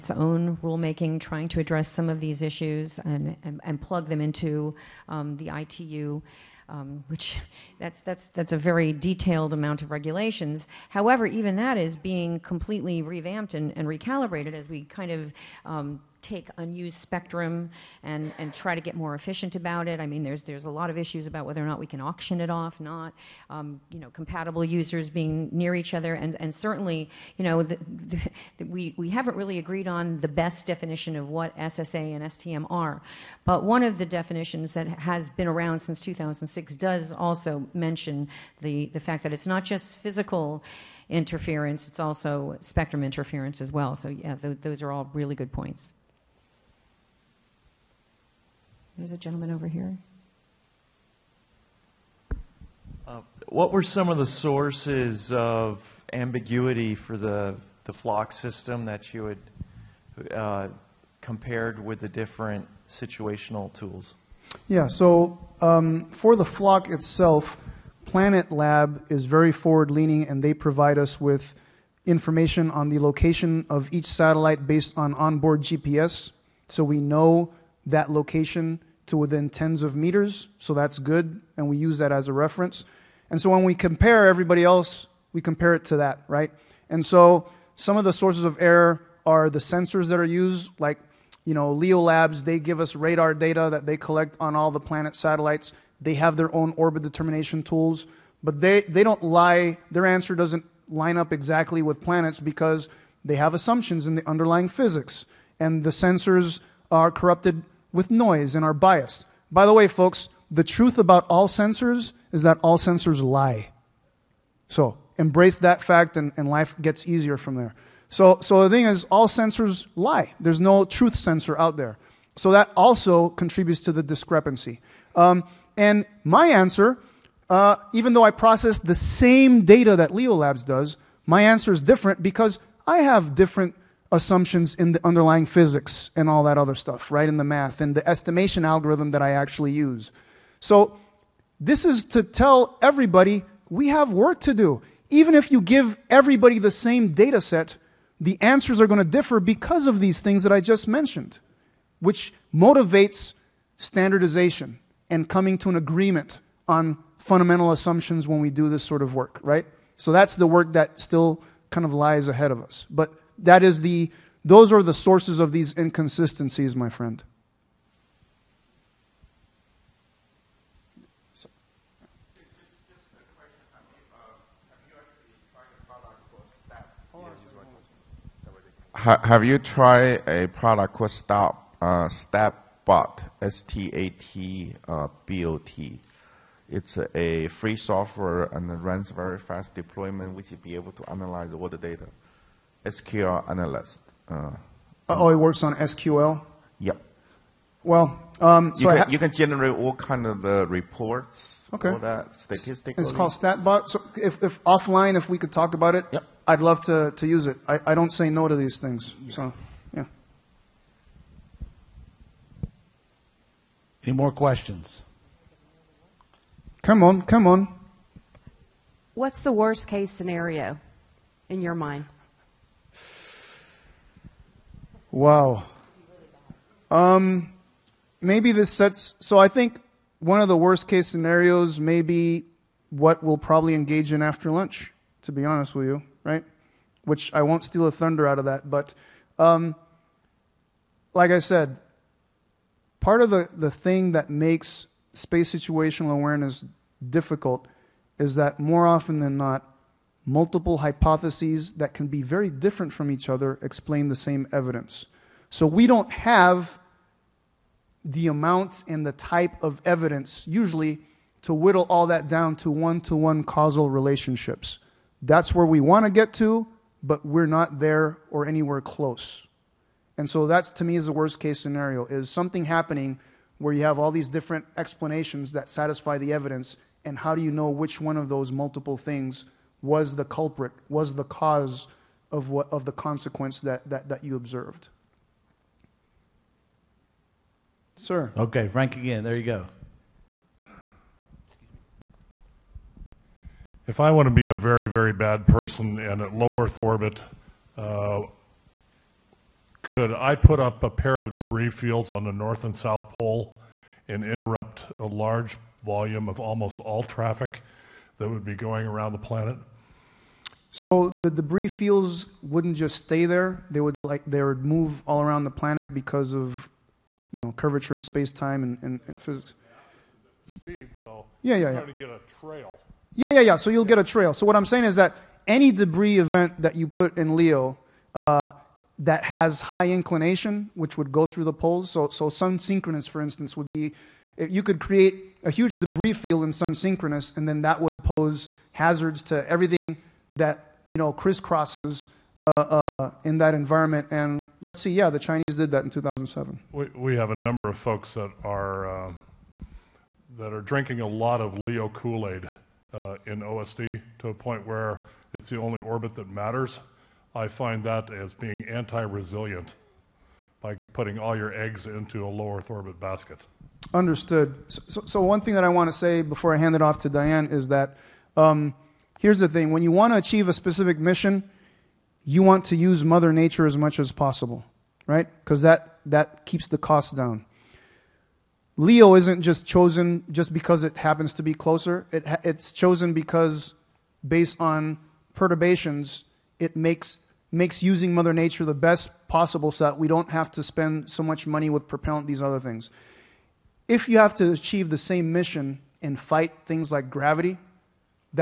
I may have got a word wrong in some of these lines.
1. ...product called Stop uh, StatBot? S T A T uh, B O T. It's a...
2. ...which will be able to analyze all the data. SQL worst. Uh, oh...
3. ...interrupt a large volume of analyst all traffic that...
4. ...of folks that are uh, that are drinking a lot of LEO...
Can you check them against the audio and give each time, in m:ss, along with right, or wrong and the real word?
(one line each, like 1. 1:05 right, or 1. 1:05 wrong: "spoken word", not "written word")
1. 3:00 right
2. 3:10 wrong: "analyst", not "worst"
3. 5:04 wrong: "almost", not "analyst"
4. 5:47 right.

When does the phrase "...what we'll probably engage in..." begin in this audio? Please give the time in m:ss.
3:52.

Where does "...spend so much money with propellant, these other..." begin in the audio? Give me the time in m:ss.
6:30.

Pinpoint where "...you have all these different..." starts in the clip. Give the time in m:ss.
4:33.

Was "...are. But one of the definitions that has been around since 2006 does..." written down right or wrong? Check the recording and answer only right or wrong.
right.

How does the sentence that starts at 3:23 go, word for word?
So if, if offline, if we could talk about it, yep.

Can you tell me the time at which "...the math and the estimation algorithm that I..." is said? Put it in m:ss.
2:17.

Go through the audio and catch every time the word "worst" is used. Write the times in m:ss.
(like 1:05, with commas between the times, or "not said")
3:39, 3:50, 4:31.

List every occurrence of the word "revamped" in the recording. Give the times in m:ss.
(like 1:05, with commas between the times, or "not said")
0:13.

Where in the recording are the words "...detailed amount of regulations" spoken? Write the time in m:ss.
0:08.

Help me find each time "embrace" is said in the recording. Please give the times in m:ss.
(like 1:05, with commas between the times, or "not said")
1:55.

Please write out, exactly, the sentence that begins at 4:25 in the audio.
That's where we want to get to, but we're not there or anywhere close.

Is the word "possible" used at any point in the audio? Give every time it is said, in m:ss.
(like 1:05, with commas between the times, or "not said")
6:14, 6:29.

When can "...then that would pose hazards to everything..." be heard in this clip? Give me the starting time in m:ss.
5:37.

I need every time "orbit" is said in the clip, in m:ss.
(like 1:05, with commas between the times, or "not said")
1:36, 4:56, 5:55, 6:02.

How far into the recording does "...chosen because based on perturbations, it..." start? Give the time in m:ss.
6:22.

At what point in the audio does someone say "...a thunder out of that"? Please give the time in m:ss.
3:57.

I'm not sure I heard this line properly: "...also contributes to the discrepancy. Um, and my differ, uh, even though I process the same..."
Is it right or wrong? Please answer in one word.
wrong.